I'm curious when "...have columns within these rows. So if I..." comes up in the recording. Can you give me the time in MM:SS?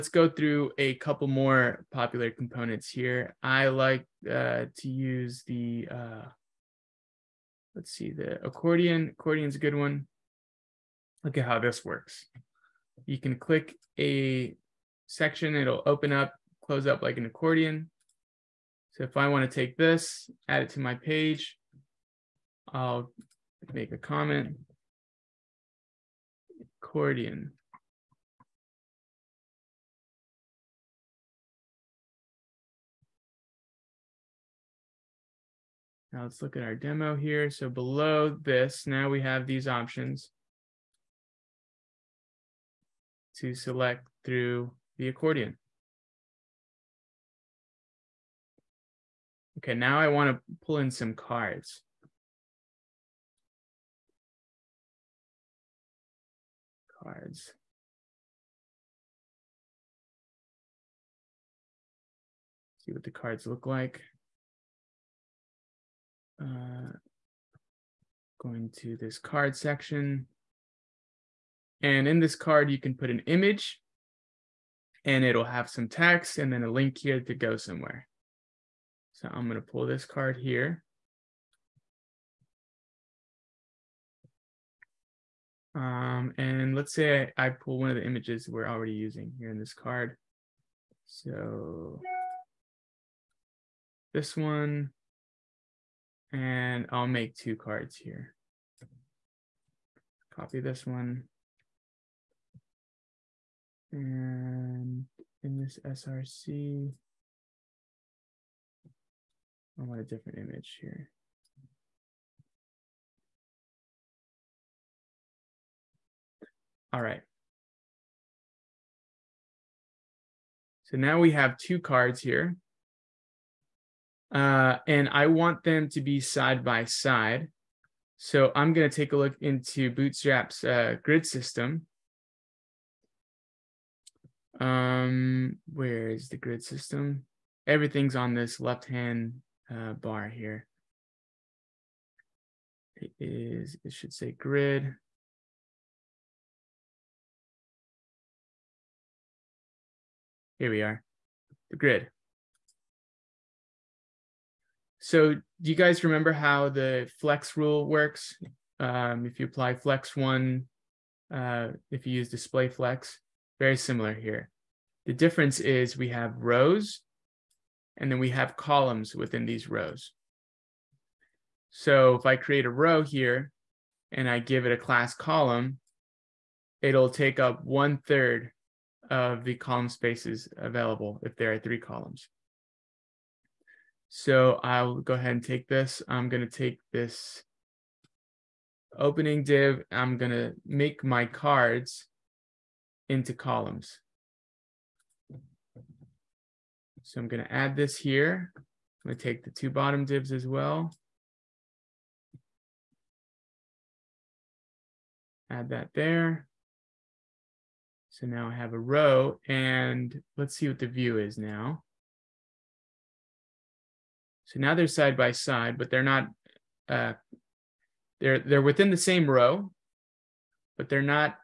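02:48.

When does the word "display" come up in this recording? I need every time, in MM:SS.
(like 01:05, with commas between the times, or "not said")
02:42.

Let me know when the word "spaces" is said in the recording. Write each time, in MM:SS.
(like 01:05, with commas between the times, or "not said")
02:59.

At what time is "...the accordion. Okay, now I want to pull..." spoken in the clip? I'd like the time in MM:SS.
00:44.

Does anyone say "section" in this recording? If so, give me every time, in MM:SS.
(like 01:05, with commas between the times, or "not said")
00:15, 01:09.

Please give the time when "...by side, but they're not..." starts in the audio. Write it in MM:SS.
03:35.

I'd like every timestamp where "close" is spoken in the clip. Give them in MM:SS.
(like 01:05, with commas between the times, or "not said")
00:16.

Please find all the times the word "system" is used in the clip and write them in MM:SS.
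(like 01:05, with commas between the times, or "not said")
02:11, 02:16.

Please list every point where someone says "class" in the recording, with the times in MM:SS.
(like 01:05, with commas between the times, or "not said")
02:54.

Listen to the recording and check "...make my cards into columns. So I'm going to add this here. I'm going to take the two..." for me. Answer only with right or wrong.
right.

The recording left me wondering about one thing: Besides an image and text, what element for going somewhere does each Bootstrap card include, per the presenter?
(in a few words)
A link.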